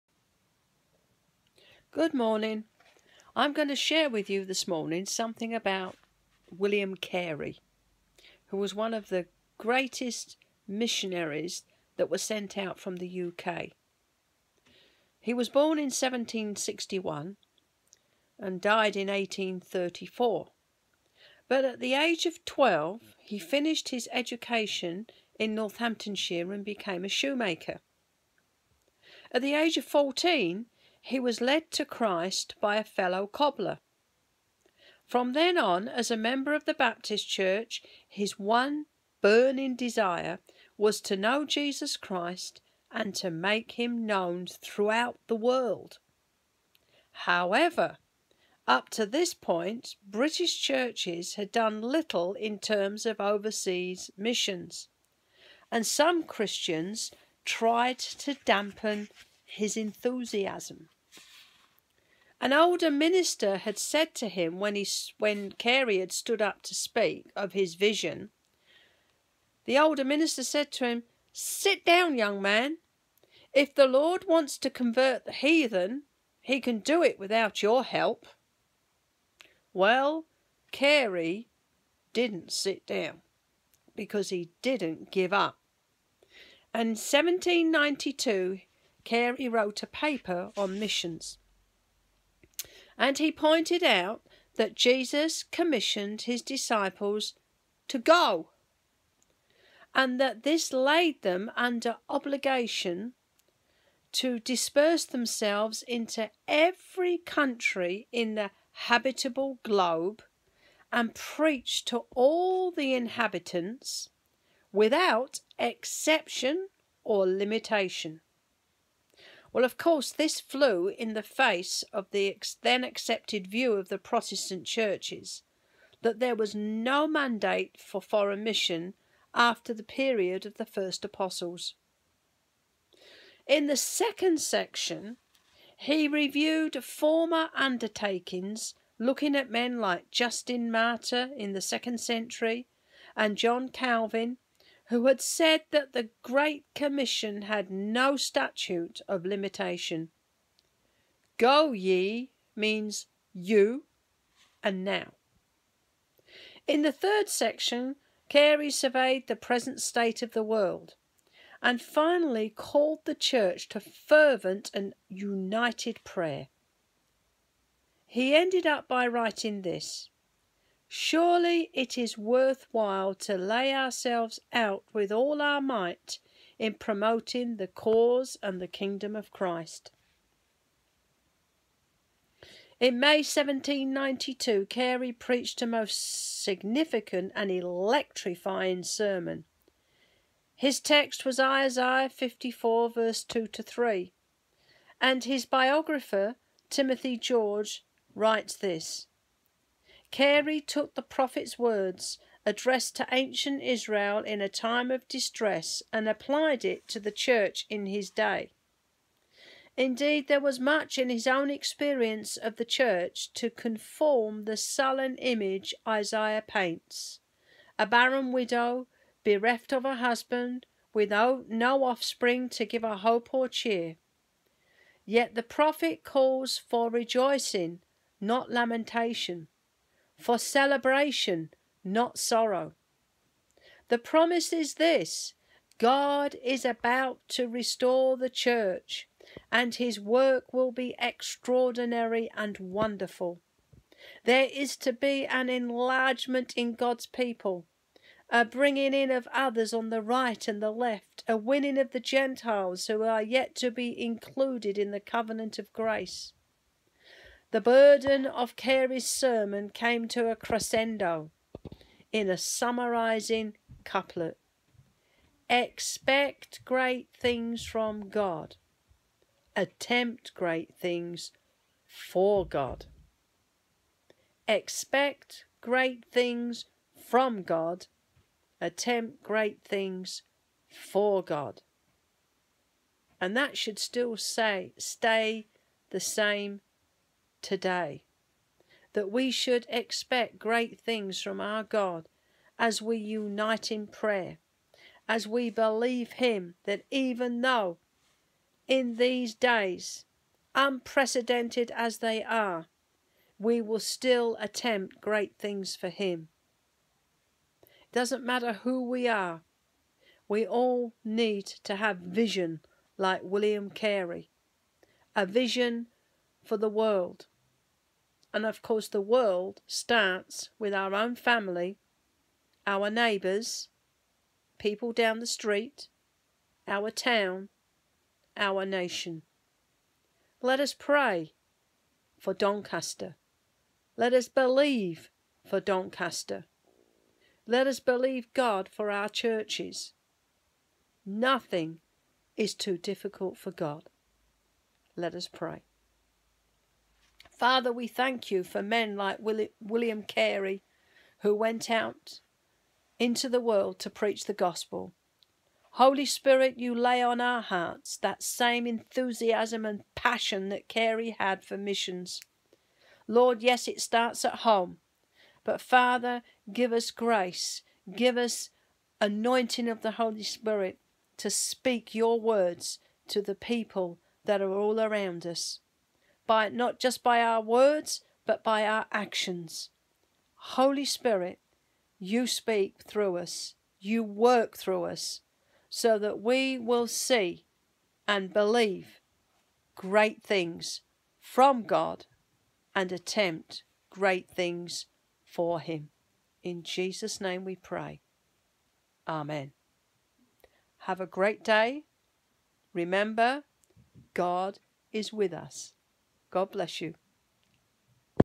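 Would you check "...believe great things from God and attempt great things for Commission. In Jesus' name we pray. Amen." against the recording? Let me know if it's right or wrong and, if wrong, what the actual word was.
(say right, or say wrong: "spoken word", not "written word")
wrong: "Him", not "Commission".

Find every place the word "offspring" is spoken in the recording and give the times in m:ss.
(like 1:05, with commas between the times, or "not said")
3:41.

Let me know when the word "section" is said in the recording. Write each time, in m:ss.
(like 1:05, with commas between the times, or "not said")
2:14, 2:37.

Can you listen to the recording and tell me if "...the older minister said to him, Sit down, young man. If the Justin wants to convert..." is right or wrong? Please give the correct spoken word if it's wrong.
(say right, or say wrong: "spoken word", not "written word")
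wrong: "Lord", not "Justin".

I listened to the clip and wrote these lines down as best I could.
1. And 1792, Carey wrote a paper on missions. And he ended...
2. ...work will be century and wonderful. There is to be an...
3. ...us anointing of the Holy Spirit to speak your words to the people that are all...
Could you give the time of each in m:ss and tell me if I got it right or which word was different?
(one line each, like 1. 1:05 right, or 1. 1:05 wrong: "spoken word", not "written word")
1. 1:26 wrong: "pointed", not "ended"
2. 3:59 wrong: "extraordinary", not "century"
3. 6:08 right.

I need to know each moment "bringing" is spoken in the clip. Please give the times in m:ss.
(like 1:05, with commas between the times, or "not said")
4:08.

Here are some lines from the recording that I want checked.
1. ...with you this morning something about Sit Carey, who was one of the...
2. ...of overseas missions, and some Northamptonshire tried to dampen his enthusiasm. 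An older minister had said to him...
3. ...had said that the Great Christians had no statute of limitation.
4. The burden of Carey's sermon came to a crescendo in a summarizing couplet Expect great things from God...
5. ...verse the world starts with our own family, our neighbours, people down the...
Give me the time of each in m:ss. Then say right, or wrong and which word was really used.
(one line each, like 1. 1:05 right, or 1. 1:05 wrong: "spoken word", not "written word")
1. 0:04 wrong: "William", not "Sit"
2. 0:53 wrong: "Christians", not "Northamptonshire"
3. 2:25 wrong: "Commission", not "Christians"
4. 4:17 right
5. 5:18 wrong: "course", not "verse".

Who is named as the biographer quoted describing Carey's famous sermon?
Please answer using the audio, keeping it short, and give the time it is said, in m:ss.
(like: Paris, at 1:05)
Timothy George, at 3:16.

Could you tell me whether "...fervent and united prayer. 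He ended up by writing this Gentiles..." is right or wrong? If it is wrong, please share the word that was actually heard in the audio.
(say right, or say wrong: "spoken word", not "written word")
wrong: "Surely", not "Gentiles".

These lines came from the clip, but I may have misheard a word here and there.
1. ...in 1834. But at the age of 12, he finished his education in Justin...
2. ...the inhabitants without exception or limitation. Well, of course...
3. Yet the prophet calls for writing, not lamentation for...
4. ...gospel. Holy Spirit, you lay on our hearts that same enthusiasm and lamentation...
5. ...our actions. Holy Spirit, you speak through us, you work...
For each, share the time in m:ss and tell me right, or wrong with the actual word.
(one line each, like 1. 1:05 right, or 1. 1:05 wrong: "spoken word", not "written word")
1. 0:18 wrong: "Northamptonshire", not "Justin"
2. 1:52 right
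3. 3:45 wrong: "rejoicing", not "writing"
4. 5:54 wrong: "passion", not "lamentation"
5. 6:18 right.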